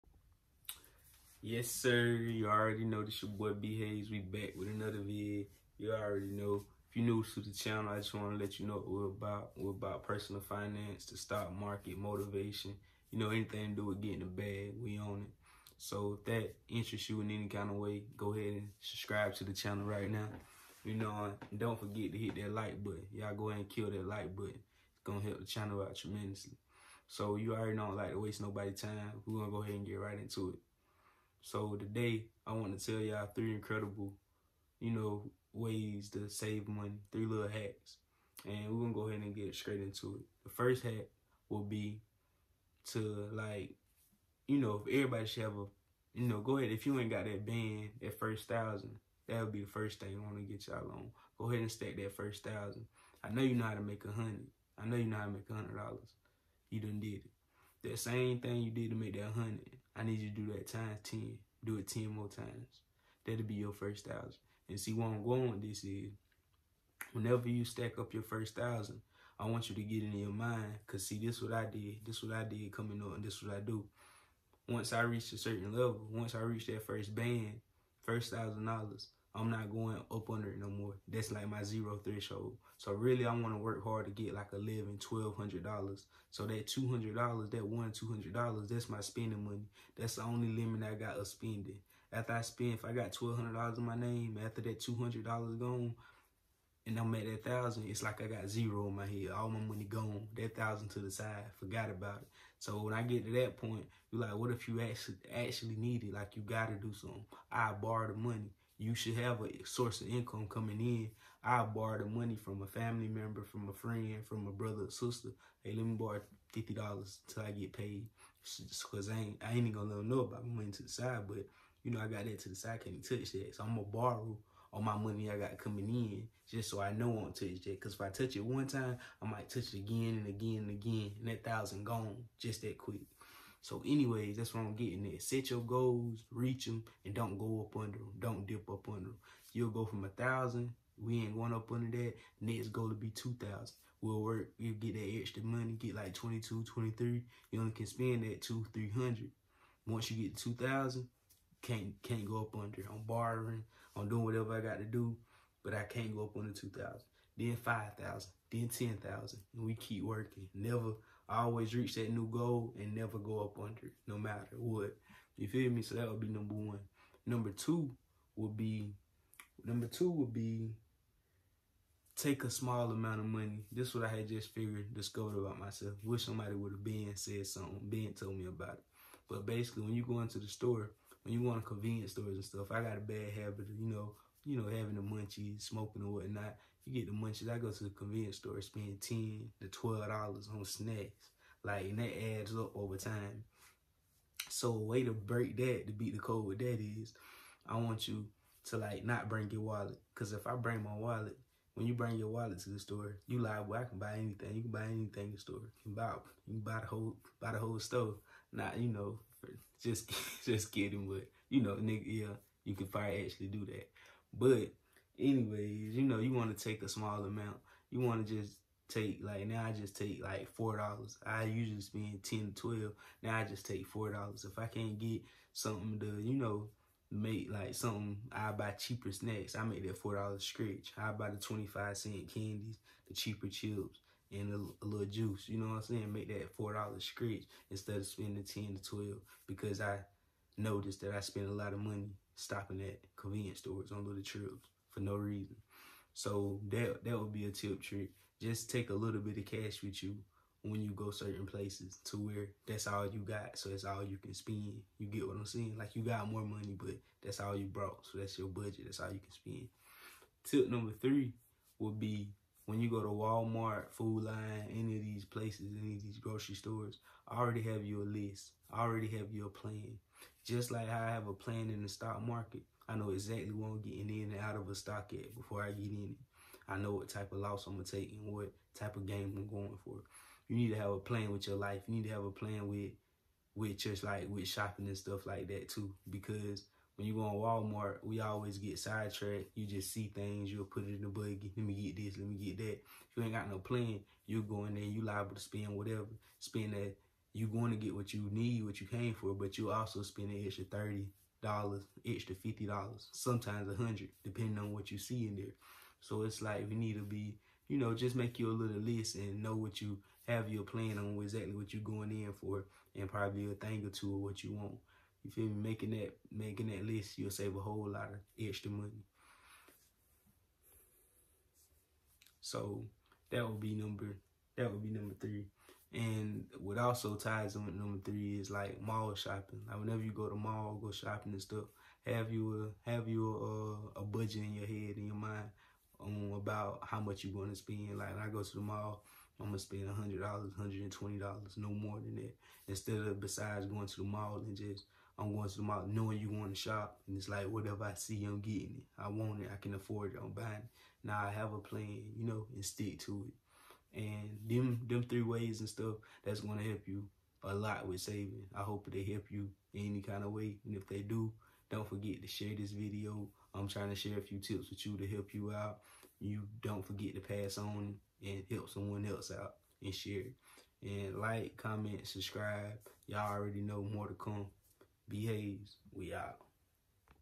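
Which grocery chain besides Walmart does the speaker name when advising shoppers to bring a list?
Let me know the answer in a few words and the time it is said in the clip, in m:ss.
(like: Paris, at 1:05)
Food Lion, at 4:23.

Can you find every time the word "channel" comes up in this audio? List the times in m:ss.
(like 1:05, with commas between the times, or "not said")
0:07, 0:19, 0:25.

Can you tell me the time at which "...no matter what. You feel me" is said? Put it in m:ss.
2:44.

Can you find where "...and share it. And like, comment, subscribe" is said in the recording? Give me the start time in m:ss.
6:09.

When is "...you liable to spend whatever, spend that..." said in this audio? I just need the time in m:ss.
4:54.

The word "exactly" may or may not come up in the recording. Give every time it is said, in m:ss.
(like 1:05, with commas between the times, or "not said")
4:33, 5:11.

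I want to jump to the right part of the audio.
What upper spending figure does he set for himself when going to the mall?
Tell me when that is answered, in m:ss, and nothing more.
5:40.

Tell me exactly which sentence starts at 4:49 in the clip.
You just see things, you'll put it in the buggy.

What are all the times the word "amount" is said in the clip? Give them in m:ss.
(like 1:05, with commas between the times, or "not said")
2:52, 3:37.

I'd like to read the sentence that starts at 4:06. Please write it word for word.
So that that would be a tip trick.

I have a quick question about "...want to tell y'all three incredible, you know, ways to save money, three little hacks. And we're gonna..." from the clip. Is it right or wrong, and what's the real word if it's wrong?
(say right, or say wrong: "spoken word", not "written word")
right.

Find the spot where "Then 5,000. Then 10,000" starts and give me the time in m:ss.
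2:37.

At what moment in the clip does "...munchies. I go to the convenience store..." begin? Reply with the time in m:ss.
3:07.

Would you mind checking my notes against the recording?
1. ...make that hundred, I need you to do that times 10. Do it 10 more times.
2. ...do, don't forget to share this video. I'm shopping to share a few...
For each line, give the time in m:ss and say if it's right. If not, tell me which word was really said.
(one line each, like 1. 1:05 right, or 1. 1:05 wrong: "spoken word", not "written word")
1. 0:58 right
2. 6:00 wrong: "trying", not "shopping".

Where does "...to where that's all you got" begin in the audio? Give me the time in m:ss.
4:12.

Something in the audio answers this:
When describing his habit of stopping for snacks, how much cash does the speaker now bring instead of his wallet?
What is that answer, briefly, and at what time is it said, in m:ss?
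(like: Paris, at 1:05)
$4, at 3:43.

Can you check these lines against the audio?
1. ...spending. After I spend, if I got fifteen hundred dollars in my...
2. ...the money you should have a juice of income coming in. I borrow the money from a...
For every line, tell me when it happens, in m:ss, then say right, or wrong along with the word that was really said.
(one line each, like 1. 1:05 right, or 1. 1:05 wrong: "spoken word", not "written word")
1. 1:31 wrong: "twelve", not "fifteen"
2. 1:48 wrong: "source", not "juice".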